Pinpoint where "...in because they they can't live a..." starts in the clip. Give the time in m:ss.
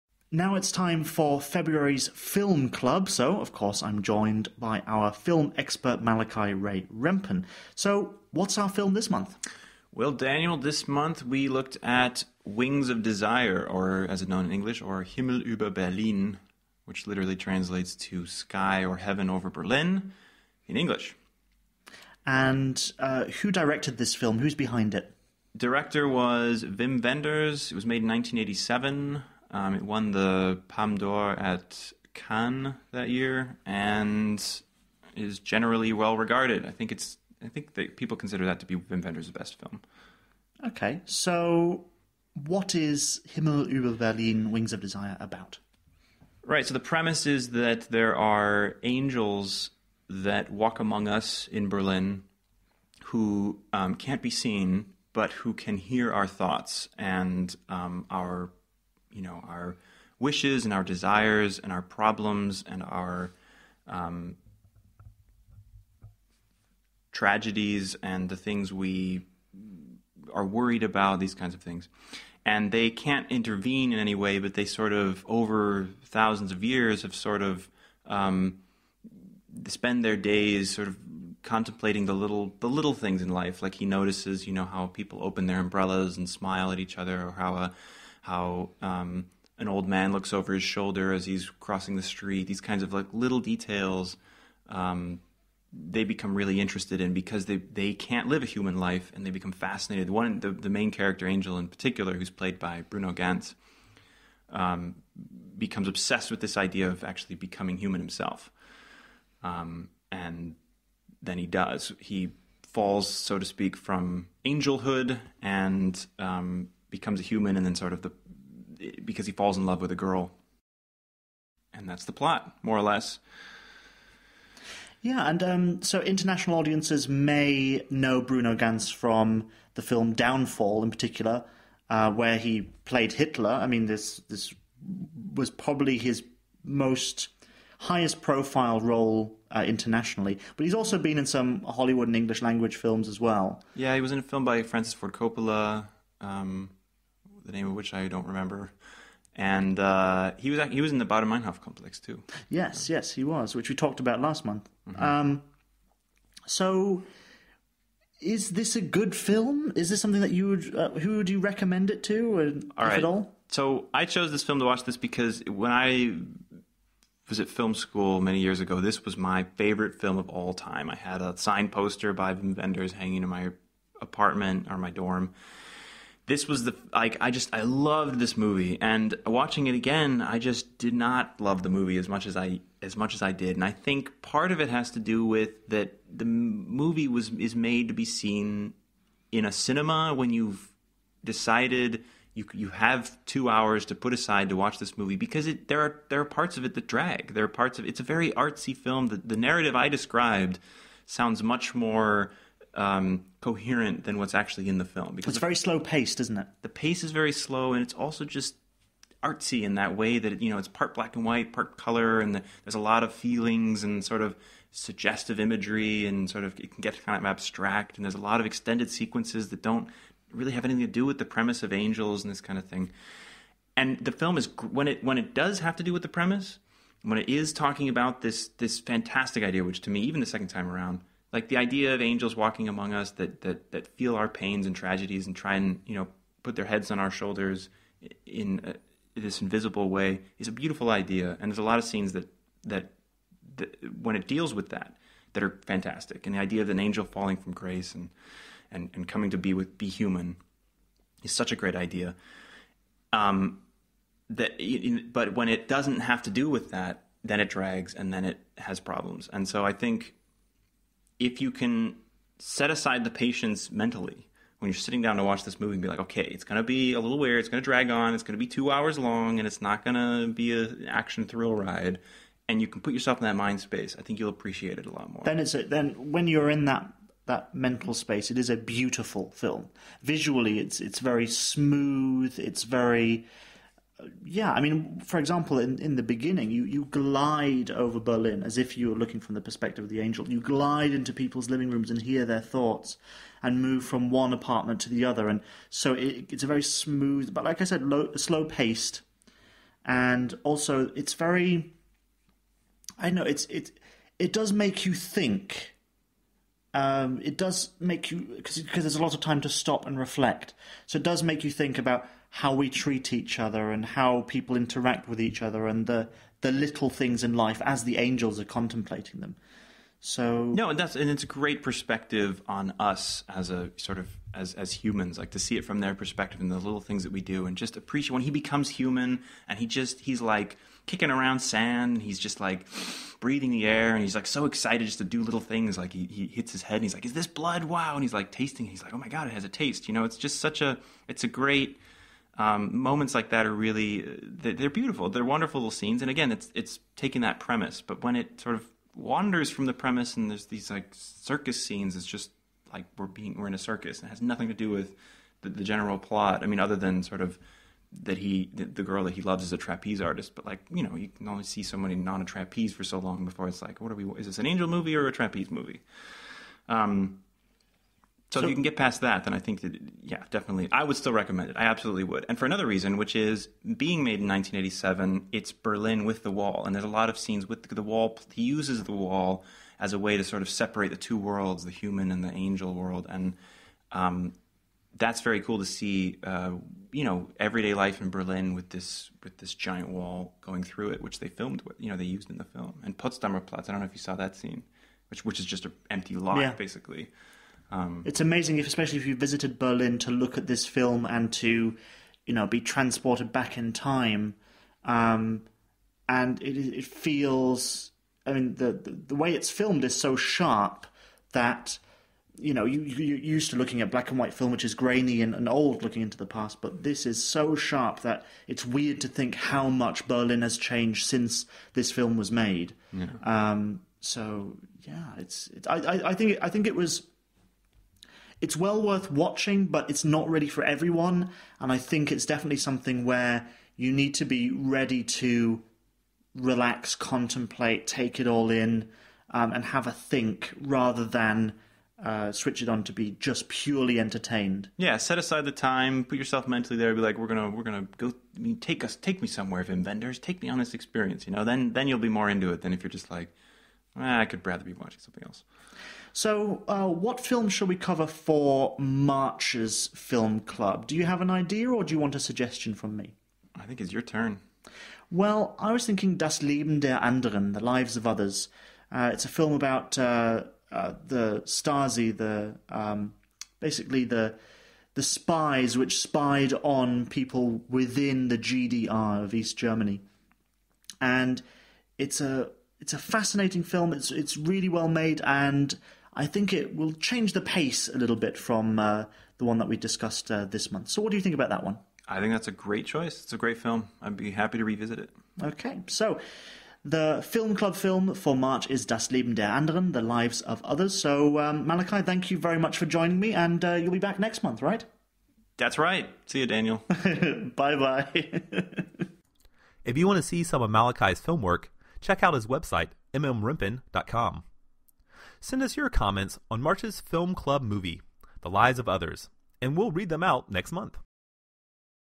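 1:37.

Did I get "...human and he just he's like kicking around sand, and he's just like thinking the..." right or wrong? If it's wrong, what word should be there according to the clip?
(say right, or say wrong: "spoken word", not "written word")
wrong: "breathing", not "thinking".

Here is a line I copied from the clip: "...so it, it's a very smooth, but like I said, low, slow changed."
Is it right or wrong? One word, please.
wrong.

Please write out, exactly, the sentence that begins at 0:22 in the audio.
And uh, who directed this film?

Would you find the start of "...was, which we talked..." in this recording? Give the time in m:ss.
2:33.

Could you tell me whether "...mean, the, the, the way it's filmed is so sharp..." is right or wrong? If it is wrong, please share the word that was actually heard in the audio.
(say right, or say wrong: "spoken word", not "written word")
right.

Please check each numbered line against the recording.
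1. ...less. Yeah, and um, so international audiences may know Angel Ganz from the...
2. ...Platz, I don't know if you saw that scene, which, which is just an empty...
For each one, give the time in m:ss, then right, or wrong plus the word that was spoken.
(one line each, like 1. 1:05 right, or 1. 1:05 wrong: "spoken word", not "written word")
1. 2:02 wrong: "Bruno", not "Angel"
2. 6:33 right.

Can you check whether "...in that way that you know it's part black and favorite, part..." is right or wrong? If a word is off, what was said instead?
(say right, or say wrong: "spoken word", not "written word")
wrong: "white", not "favorite".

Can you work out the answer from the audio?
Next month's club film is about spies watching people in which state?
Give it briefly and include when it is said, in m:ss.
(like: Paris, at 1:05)
the GDR, at 7:58.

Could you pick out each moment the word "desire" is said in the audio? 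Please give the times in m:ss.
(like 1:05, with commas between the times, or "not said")
0:13, 0:44, 1:00.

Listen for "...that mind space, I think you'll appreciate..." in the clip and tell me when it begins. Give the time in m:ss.
4:33.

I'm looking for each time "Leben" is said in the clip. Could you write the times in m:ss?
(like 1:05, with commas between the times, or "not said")
7:46, 8:19.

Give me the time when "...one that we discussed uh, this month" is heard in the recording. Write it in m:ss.
8:09.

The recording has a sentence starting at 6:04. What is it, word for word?
Is this an angel movie or a trapeze movie?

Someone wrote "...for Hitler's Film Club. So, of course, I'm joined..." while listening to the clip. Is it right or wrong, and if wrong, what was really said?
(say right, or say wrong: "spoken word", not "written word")
wrong: "February", not "Hitler".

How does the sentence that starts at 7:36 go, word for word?
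So, uh, what film shall we cover for March's film club?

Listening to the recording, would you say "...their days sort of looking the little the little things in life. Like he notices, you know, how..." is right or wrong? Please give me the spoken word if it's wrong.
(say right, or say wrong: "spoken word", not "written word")
wrong: "contemplating", not "looking".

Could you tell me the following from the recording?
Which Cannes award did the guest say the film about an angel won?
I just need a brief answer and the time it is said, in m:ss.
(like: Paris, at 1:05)
Palme d'Or, at 0:30.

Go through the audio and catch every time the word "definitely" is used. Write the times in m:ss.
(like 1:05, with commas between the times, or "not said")
6:10, 7:12.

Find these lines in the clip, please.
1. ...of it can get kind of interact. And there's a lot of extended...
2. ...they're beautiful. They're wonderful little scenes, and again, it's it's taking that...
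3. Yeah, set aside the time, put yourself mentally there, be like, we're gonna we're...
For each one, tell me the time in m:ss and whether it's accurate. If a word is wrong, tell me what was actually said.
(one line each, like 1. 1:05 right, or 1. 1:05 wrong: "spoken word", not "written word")
1. 3:36 wrong: "abstract", not "interact"
2. 5:44 right
3. 7:24 right.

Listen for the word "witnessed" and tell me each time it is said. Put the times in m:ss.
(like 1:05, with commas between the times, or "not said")
not said.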